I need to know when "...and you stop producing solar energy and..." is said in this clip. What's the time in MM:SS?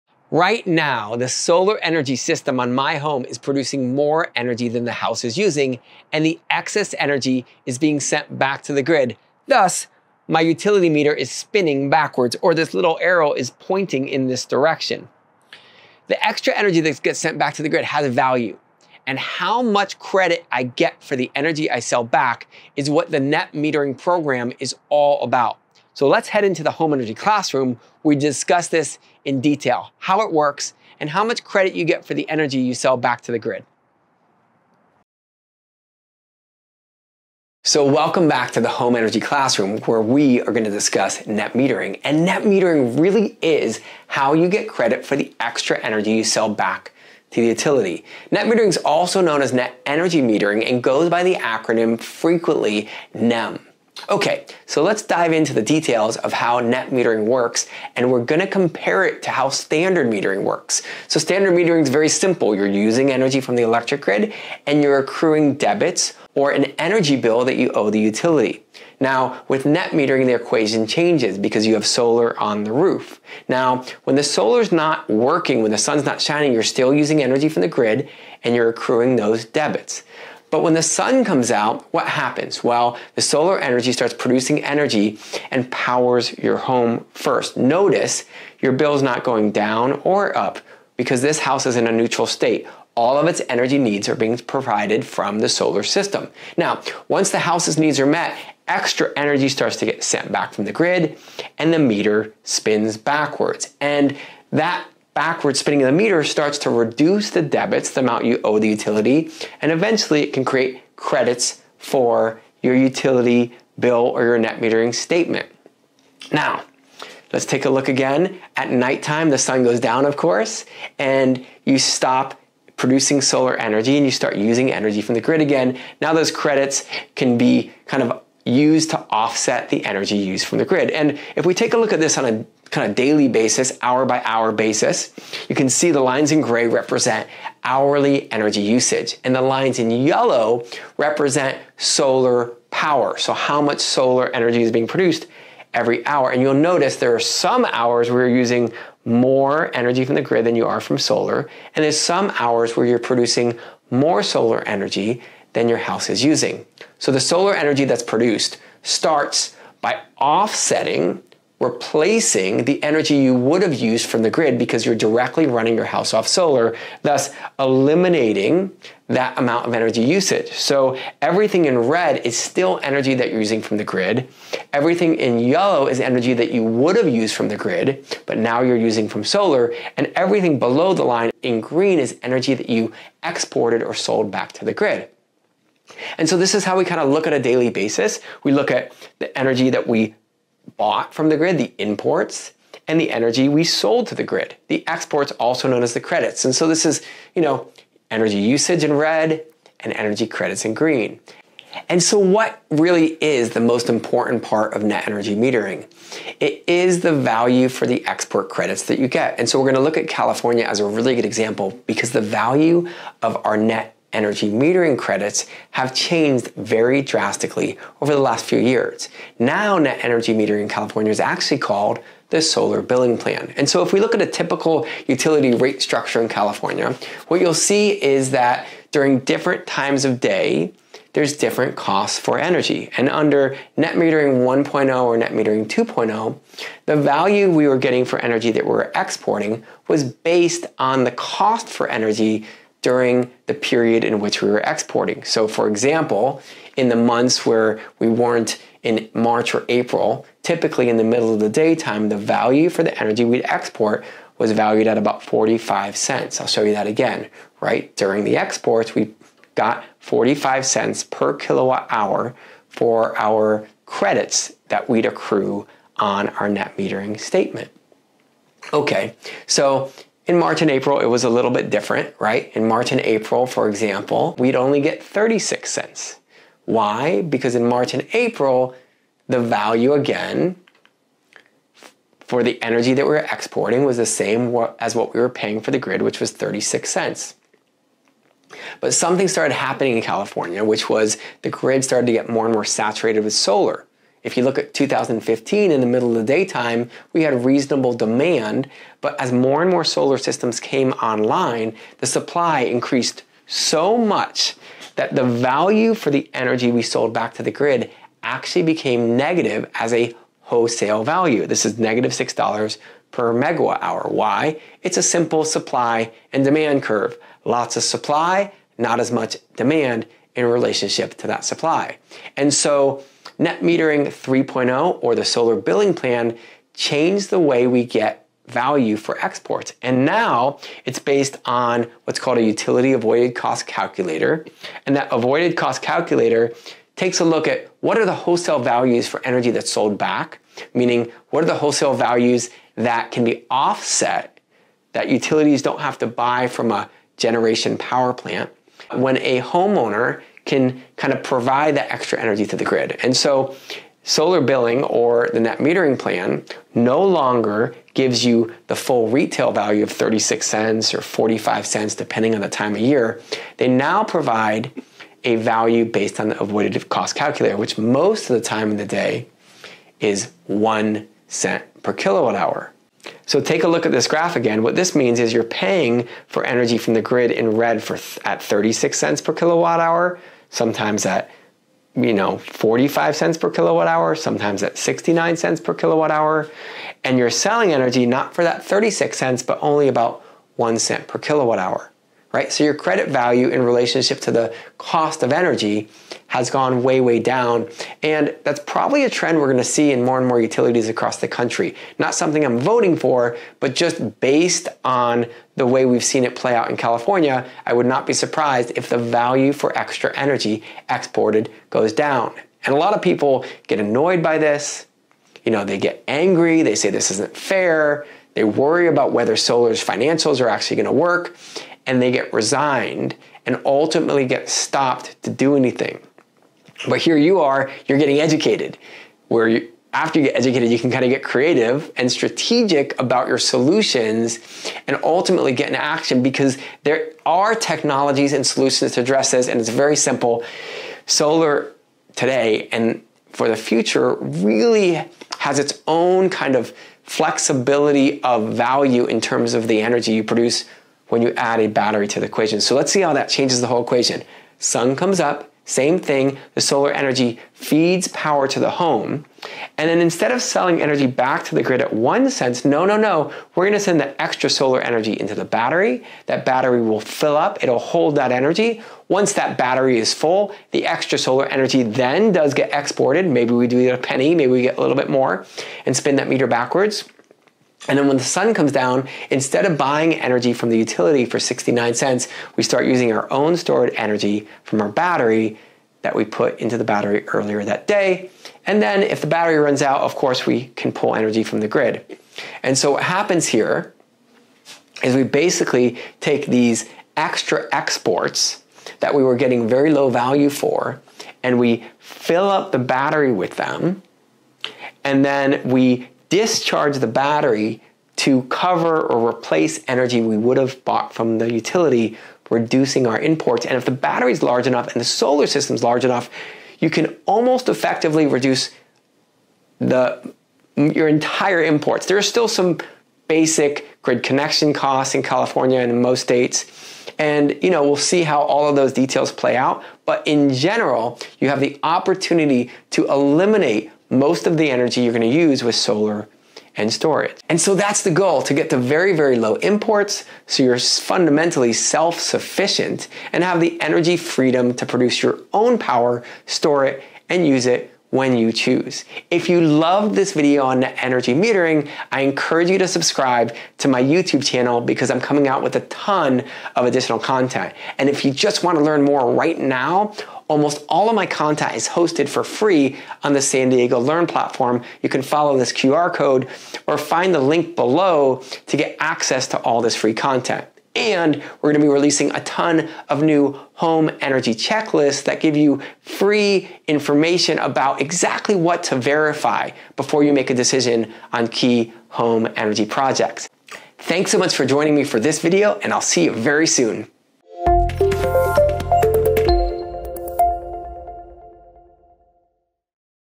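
02:00.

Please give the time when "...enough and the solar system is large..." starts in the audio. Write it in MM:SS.
08:34.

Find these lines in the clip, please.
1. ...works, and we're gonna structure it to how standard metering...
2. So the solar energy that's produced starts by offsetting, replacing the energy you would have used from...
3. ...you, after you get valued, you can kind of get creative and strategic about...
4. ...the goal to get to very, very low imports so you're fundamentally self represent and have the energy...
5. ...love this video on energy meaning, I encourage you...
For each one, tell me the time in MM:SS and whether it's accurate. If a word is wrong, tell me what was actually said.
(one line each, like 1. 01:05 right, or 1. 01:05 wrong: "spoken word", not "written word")
1. 00:57 wrong: "compare", not "structure"
2. 02:37 right
3. 07:09 wrong: "educated", not "valued"
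4. 08:58 wrong: "sufficient", not "represent"
5. 09:09 wrong: "metering", not "meaning".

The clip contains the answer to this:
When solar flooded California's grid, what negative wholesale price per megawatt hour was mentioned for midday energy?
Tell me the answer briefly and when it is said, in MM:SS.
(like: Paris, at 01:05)
-$6, at 05:11.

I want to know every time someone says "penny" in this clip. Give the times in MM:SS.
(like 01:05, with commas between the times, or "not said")
07:54.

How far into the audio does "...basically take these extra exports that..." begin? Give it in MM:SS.
08:15.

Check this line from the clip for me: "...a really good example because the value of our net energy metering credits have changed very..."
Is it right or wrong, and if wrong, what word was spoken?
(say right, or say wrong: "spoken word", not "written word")
right.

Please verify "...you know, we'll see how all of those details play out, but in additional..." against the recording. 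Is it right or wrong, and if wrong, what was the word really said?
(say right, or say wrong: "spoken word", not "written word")
wrong: "general", not "additional".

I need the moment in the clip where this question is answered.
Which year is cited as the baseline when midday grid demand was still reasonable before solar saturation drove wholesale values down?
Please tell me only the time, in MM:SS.
04:54.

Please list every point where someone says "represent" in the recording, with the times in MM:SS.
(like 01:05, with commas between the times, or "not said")
02:16, 02:20.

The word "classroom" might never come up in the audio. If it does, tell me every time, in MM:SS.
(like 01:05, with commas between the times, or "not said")
00:27, 00:39.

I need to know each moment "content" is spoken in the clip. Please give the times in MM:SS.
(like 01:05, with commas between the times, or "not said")
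09:17, 09:21, 09:30.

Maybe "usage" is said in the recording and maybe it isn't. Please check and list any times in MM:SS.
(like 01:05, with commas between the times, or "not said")
02:18, 02:50, 03:18.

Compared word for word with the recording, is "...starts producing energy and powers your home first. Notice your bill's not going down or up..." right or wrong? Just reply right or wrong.
right.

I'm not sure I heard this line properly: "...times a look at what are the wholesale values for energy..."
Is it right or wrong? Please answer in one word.
wrong.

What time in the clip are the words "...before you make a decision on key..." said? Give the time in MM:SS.
09:39.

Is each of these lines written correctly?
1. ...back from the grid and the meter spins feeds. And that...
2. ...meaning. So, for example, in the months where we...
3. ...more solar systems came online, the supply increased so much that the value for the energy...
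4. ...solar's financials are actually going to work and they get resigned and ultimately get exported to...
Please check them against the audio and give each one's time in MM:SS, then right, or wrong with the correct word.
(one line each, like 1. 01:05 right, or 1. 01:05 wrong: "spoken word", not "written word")
1. 01:40 wrong: "backwards", not "feeds"
2. 04:04 wrong: "exporting", not "meaning"
3. 04:59 right
4. 06:59 wrong: "stopped", not "exported".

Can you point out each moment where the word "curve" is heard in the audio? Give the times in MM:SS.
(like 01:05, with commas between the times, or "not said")
05:16.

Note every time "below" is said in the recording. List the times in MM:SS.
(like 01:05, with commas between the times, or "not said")
03:00, 09:27.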